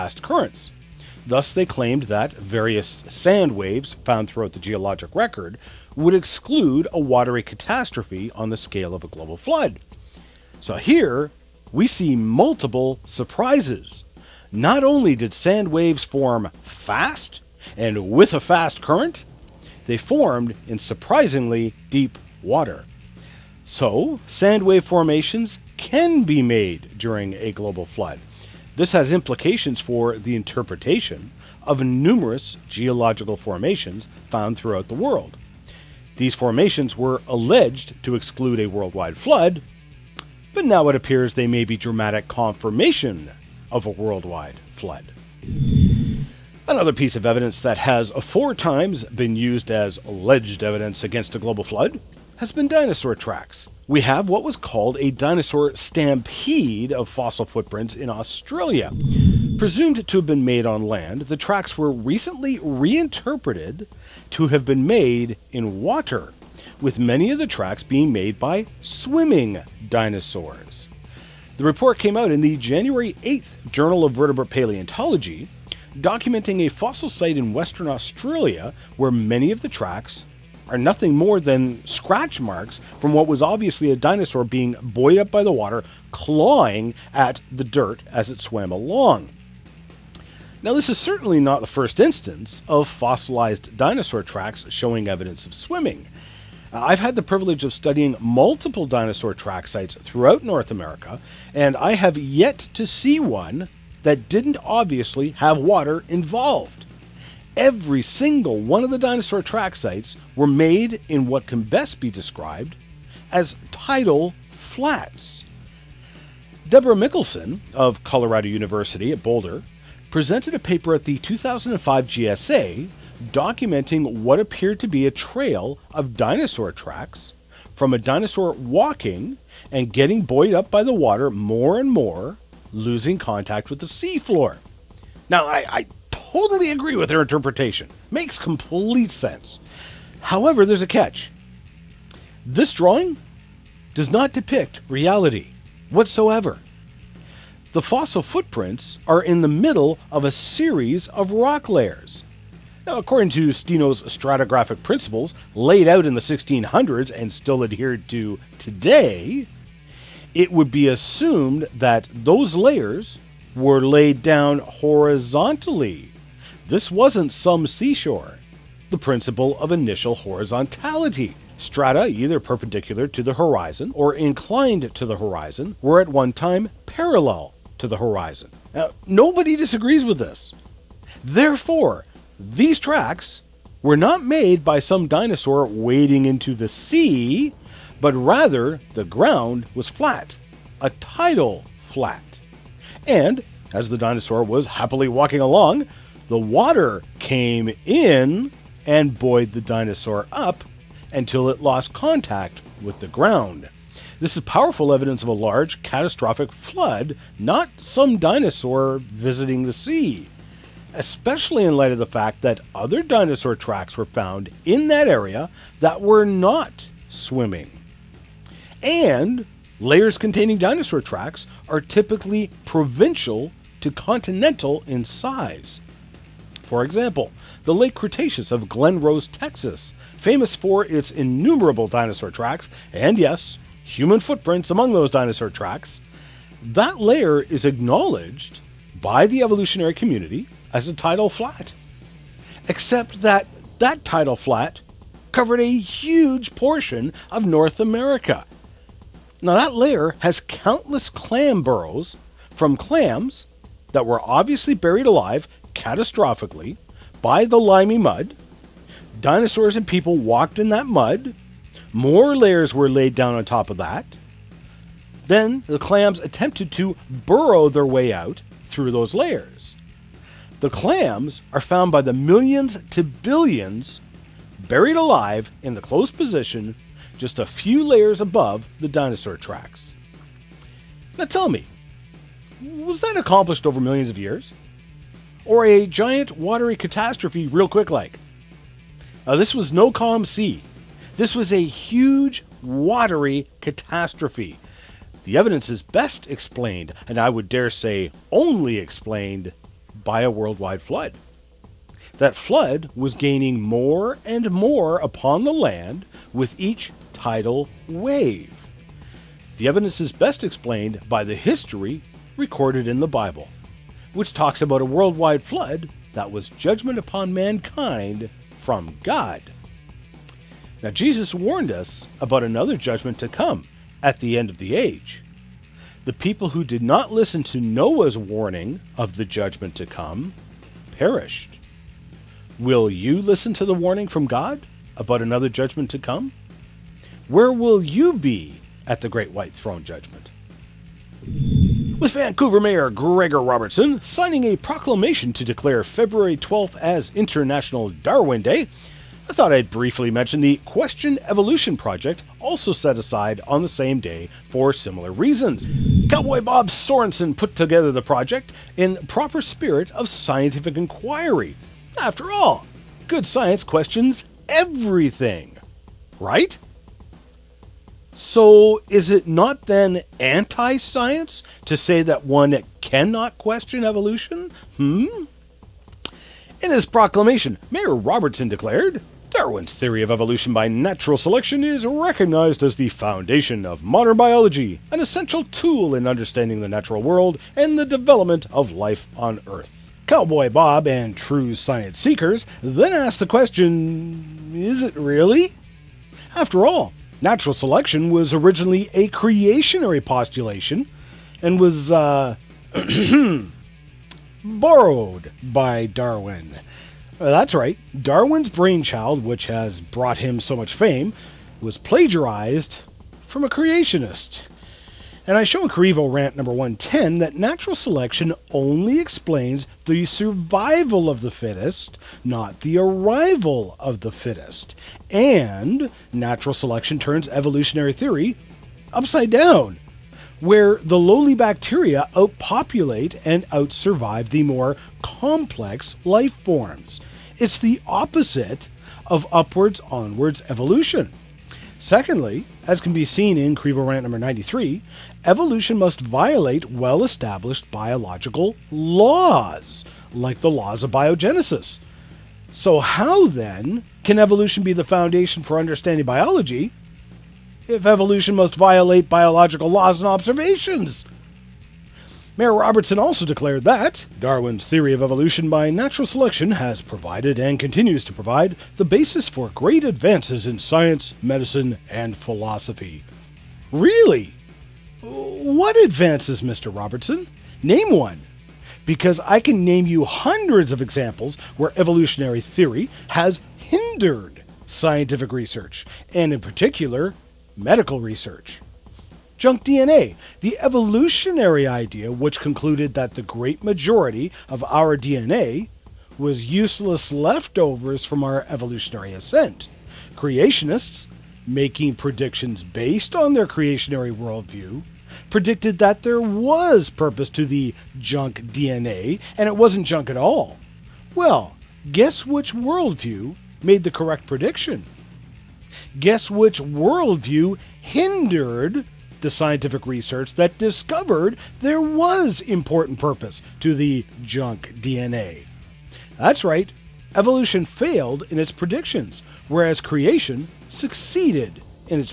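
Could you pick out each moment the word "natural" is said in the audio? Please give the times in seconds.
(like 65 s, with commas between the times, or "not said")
380 s, 386 s, 397 s, 417 s, 426 s, 465 s.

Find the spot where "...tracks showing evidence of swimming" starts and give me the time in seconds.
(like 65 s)
94 s.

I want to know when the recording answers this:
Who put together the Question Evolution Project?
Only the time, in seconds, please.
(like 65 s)
356 s.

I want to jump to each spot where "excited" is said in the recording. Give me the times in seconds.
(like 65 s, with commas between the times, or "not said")
not said.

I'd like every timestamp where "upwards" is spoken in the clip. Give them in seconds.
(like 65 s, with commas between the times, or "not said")
439 s.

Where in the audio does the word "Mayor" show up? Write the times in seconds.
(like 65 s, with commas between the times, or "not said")
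342 s, 377 s, 462 s.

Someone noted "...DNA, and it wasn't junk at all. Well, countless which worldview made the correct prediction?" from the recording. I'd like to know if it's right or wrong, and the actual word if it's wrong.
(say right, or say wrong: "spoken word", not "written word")
wrong: "guess", not "countless".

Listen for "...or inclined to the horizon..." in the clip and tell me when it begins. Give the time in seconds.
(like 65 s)
173 s.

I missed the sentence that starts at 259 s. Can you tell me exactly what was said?
Dinosaurs and people walked in that mud.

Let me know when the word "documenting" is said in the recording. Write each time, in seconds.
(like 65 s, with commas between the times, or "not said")
75 s, 123 s.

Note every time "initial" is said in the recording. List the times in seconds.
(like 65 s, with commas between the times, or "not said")
169 s.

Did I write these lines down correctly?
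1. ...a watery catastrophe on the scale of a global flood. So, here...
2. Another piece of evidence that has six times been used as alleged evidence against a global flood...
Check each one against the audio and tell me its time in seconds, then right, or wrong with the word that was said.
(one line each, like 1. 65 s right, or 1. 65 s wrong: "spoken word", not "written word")
1. 6 s right
2. 46 s wrong: "four", not "six".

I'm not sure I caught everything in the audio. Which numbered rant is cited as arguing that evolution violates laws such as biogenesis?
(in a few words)
93.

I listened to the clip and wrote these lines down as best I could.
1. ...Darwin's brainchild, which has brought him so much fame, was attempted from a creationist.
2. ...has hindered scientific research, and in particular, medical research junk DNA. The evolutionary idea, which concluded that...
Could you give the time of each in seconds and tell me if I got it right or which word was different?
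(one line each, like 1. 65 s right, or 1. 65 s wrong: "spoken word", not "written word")
1. 407 s wrong: "plagiarized", not "attempted"
2. 483 s right.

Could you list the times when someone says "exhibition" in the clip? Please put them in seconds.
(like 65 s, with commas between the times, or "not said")
not said.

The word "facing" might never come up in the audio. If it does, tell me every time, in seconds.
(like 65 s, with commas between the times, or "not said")
not said.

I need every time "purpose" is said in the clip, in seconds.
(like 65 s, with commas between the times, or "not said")
506 s, 522 s.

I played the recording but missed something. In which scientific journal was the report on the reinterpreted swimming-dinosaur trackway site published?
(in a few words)
Journal of Vertebrate Paleontology.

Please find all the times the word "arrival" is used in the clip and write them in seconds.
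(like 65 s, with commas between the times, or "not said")
422 s.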